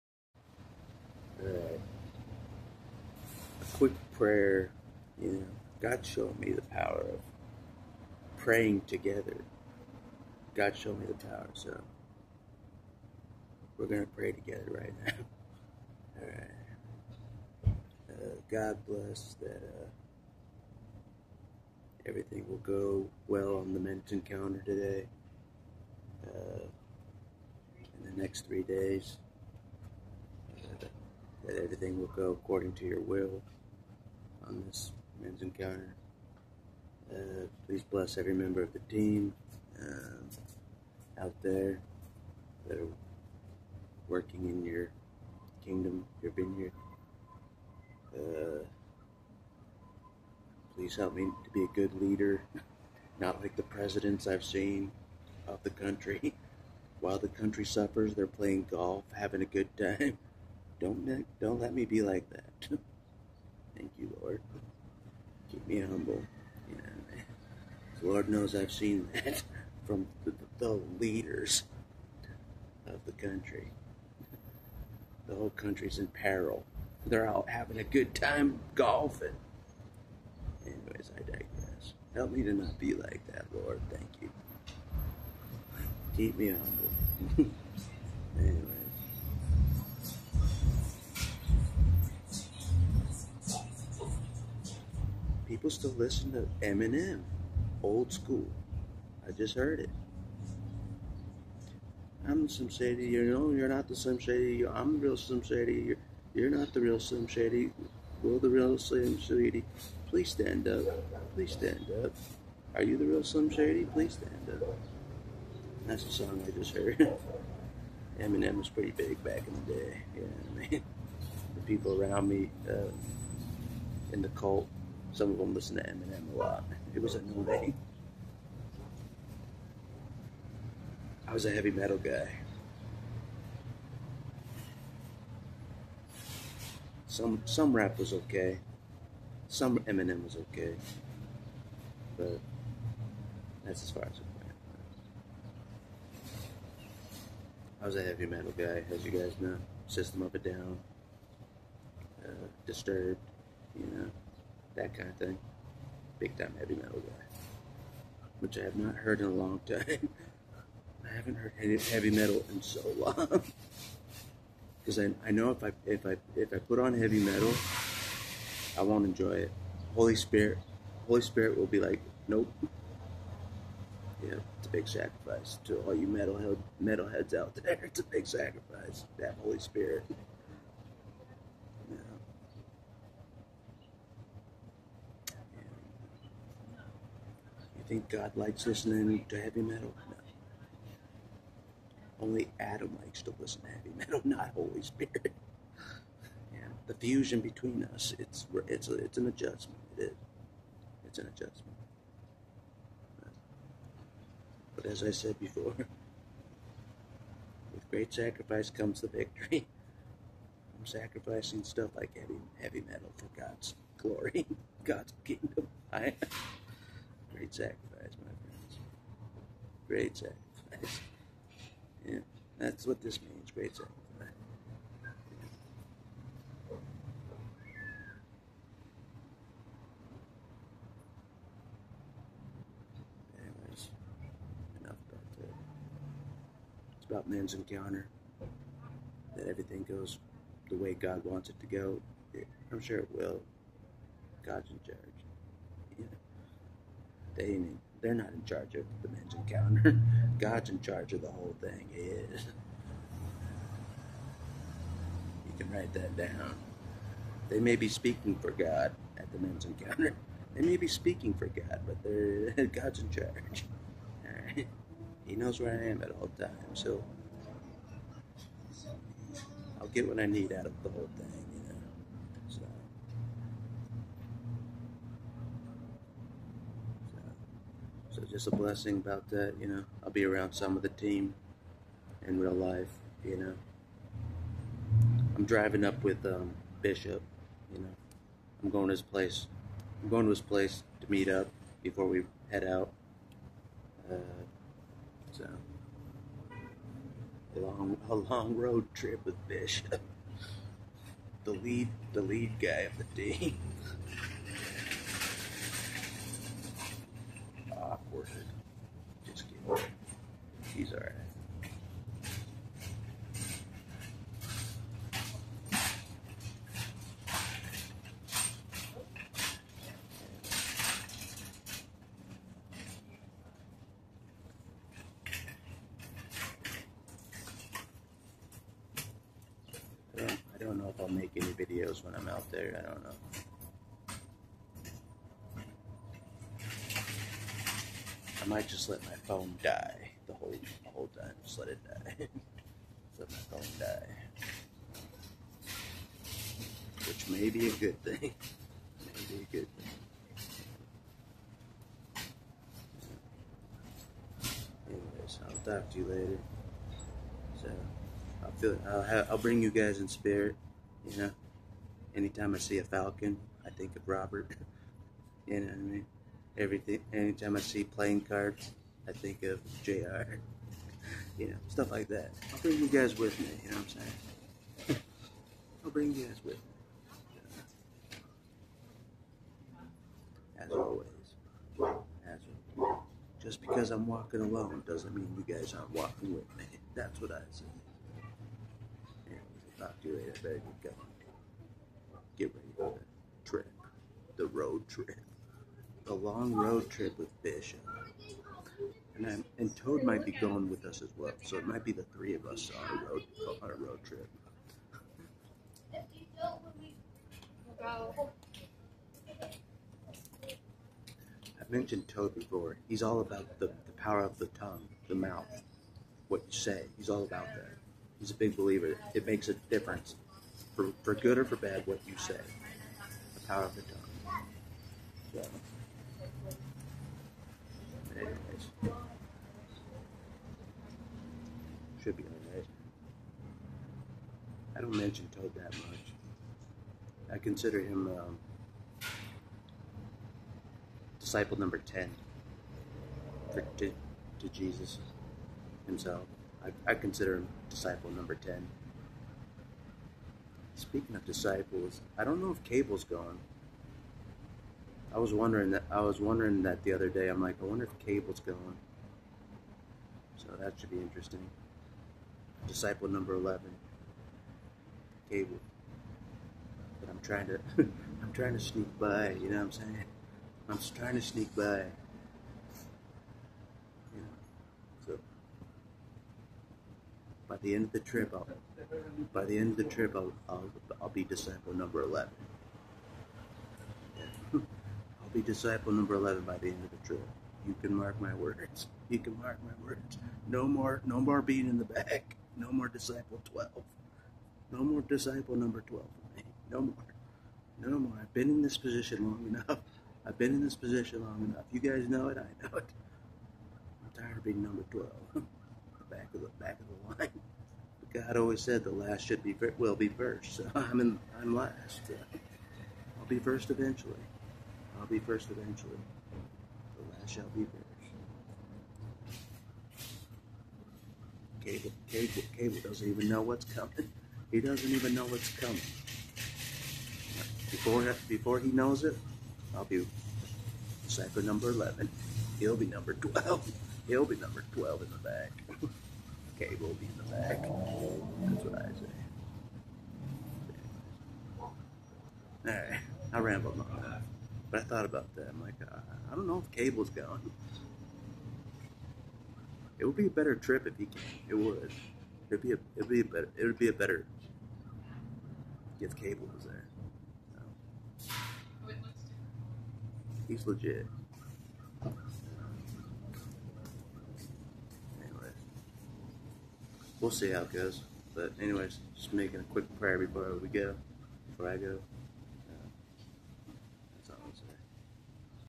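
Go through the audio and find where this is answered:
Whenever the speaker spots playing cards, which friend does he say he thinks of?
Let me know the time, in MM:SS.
06:09.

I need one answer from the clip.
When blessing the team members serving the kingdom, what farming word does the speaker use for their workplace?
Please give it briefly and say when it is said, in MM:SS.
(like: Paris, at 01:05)
vineyard, at 00:46.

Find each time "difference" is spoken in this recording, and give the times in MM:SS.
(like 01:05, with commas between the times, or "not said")
06:59.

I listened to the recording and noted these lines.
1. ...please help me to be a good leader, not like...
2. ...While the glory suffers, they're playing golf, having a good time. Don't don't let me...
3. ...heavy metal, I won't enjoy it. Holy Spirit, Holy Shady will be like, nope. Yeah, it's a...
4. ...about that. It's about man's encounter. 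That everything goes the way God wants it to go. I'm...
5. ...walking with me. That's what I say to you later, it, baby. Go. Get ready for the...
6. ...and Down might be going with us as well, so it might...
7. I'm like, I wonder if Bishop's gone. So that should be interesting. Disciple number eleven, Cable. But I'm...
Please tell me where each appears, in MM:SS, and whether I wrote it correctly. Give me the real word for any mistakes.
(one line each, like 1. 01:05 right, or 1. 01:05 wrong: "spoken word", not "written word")
1. 00:50 right
2. 00:56 wrong: "country", not "glory"
3. 02:46 wrong: "Spirit", not "Shady"
4. 03:55 right
5. 06:25 right
6. 06:39 wrong: "Toad", not "Down"
7. 07:37 wrong: "Cable", not "Bishop".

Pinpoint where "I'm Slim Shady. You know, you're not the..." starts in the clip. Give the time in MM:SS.
01:42.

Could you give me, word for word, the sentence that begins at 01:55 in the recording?
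That's the song I just heard.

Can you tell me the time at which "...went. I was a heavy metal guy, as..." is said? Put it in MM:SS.
02:24.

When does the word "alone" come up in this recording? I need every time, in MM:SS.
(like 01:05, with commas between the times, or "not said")
06:24.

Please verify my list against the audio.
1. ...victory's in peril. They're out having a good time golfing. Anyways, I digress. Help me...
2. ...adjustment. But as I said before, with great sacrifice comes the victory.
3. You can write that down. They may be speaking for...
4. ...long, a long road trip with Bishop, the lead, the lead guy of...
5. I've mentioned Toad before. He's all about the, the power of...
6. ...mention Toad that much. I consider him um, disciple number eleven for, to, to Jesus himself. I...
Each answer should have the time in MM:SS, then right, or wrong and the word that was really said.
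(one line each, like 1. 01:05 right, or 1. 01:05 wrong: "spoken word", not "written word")
1. 01:15 wrong: "country", not "victory"
2. 03:21 right
3. 04:15 right
4. 04:57 right
5. 06:51 right
6. 07:14 wrong: "ten", not "eleven".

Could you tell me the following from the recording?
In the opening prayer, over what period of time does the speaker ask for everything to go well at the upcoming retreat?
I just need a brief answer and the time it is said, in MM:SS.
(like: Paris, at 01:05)
next 3 days, at 00:28.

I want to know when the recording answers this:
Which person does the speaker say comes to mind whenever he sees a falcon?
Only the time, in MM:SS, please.
06:04.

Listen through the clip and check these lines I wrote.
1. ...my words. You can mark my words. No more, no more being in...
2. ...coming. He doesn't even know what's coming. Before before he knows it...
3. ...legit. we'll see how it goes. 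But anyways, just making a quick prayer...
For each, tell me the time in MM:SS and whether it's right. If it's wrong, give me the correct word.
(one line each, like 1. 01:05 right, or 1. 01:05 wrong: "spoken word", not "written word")
1. 08:08 right
2. 08:43 right
3. 09:20 right.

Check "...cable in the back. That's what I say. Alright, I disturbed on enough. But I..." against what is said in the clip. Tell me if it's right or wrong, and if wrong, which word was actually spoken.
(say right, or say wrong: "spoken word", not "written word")
wrong: "rambled", not "disturbed".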